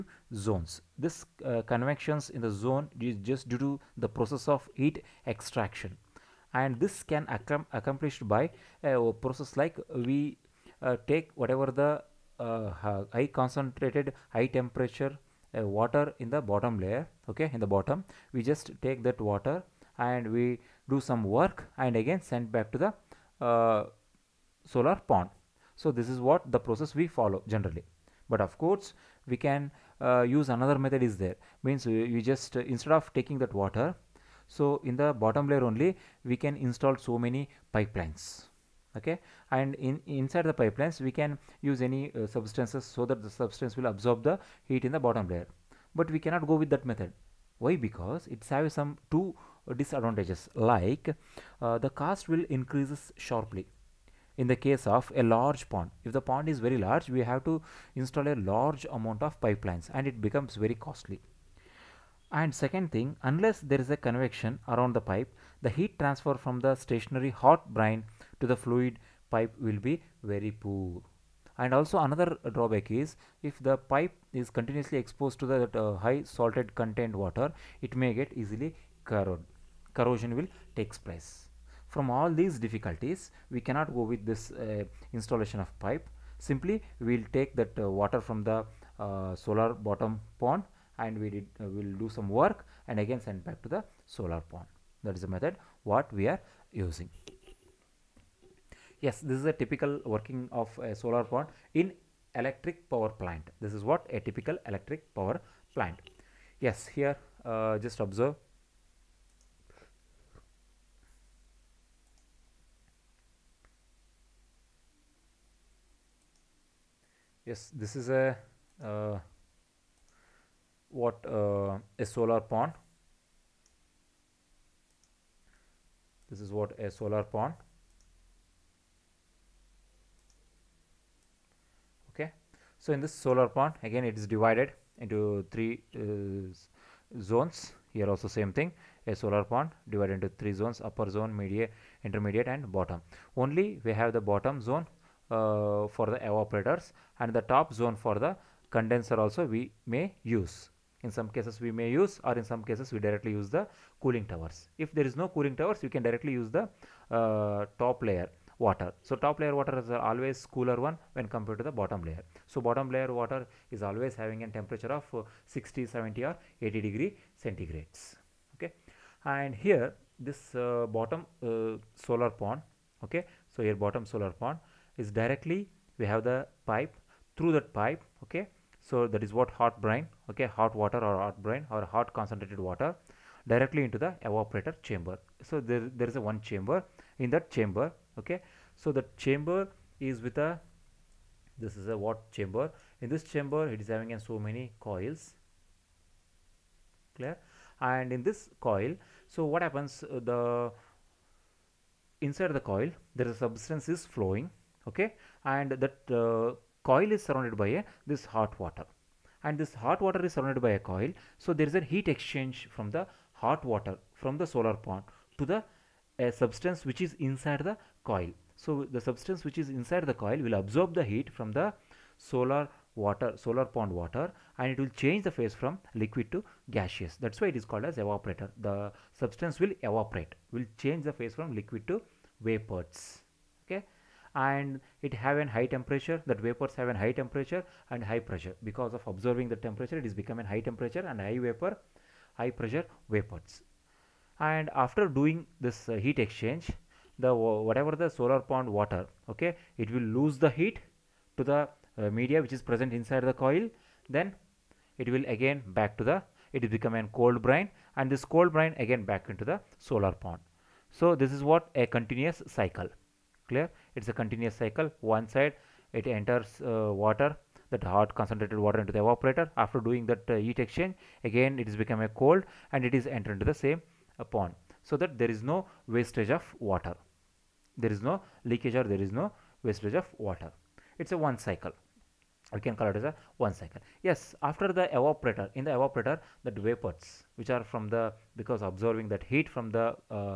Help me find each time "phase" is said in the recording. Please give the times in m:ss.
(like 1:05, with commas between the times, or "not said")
3:45, 3:51.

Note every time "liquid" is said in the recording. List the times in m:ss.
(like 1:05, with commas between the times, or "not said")
3:45, 3:51.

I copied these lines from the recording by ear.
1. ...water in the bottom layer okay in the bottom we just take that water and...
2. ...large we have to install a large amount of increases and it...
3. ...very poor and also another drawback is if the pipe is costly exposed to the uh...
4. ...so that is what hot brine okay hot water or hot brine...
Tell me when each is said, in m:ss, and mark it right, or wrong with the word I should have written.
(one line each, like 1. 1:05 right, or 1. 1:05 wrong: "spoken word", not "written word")
1. 0:15 right
2. 0:56 wrong: "pipelines", not "increases"
3. 1:10 wrong: "continuously", not "costly"
4. 2:58 right.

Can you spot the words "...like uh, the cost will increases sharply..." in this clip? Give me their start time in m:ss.
0:50.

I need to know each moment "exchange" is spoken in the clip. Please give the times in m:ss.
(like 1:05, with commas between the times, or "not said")
3:32, 4:06, 4:30.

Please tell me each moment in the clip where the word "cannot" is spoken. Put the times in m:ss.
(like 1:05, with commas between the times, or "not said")
0:46, 1:23.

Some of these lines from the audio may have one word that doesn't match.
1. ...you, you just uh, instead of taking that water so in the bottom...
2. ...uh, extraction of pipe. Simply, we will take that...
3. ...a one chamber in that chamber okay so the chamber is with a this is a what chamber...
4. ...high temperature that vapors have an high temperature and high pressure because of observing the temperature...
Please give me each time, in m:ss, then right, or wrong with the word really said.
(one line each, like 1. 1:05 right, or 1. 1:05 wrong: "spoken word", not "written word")
1. 0:31 right
2. 1:24 wrong: "installation", not "extraction"
3. 3:06 right
4. 3:55 right.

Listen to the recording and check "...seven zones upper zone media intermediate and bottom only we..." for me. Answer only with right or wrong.
wrong.